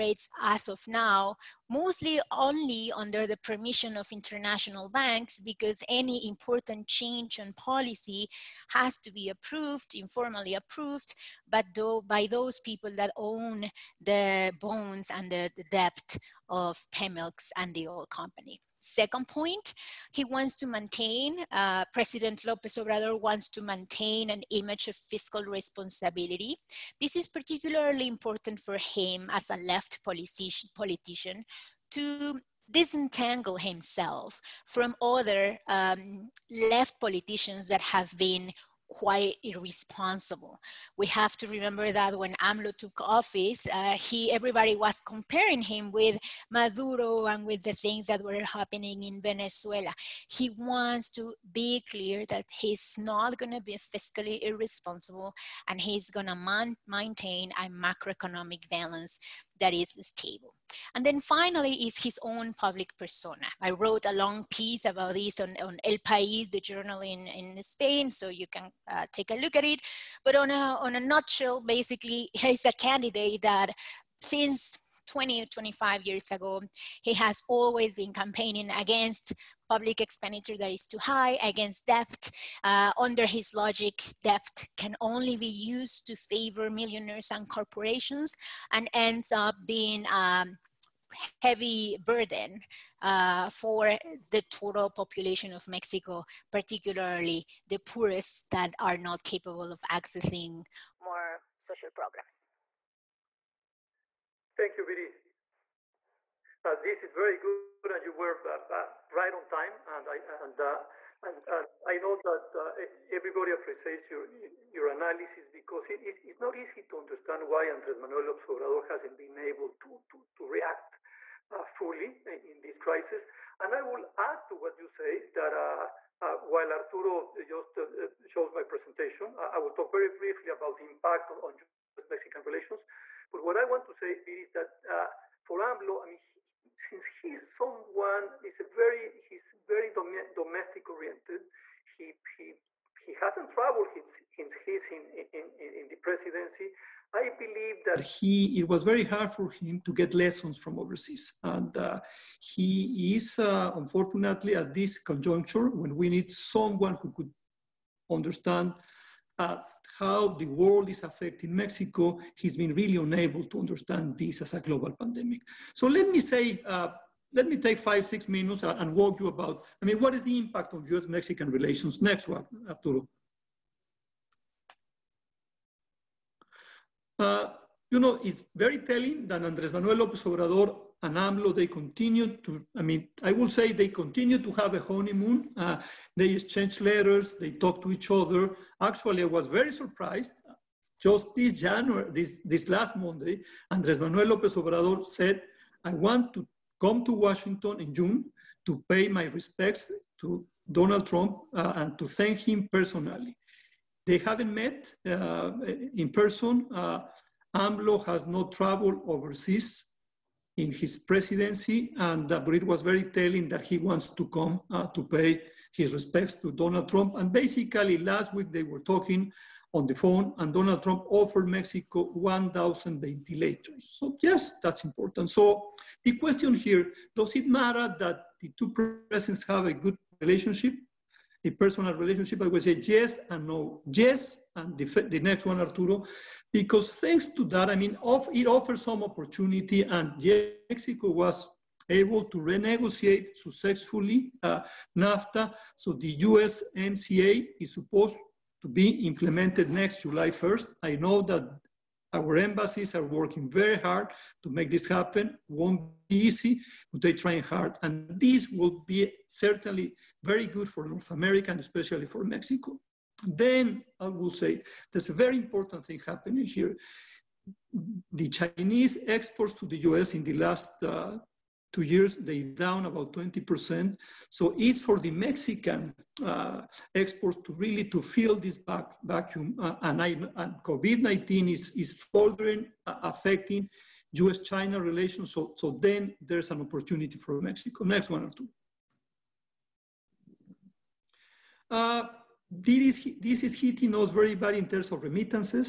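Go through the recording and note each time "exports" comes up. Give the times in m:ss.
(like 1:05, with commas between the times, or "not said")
4:29, 4:36.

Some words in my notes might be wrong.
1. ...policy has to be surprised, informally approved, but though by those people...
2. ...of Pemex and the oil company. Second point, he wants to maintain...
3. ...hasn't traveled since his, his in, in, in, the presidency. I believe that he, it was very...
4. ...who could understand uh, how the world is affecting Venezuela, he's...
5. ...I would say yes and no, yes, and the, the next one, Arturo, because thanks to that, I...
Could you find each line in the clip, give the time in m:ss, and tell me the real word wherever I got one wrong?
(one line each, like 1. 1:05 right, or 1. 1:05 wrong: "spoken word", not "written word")
1. 0:07 wrong: "approved", not "surprised"
2. 0:16 right
3. 2:23 right
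4. 2:37 wrong: "Mexico", not "Venezuela"
5. 3:52 right.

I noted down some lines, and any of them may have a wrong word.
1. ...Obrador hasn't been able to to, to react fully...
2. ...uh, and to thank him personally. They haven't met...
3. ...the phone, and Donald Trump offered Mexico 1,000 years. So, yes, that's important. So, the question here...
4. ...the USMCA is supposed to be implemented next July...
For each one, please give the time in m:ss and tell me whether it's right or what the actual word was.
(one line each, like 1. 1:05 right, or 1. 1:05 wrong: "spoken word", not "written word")
1. 1:58 right
2. 3:21 right
3. 3:39 wrong: "ventilators", not "years"
4. 4:05 right.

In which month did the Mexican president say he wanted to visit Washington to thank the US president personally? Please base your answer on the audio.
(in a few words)
June.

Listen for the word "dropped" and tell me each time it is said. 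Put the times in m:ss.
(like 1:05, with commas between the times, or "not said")
not said.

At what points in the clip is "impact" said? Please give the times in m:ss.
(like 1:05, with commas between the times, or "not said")
2:10, 2:50.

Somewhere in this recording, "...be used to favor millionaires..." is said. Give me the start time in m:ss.
1:25.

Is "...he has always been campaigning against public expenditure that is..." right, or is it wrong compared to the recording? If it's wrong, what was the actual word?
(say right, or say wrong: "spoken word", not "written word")
right.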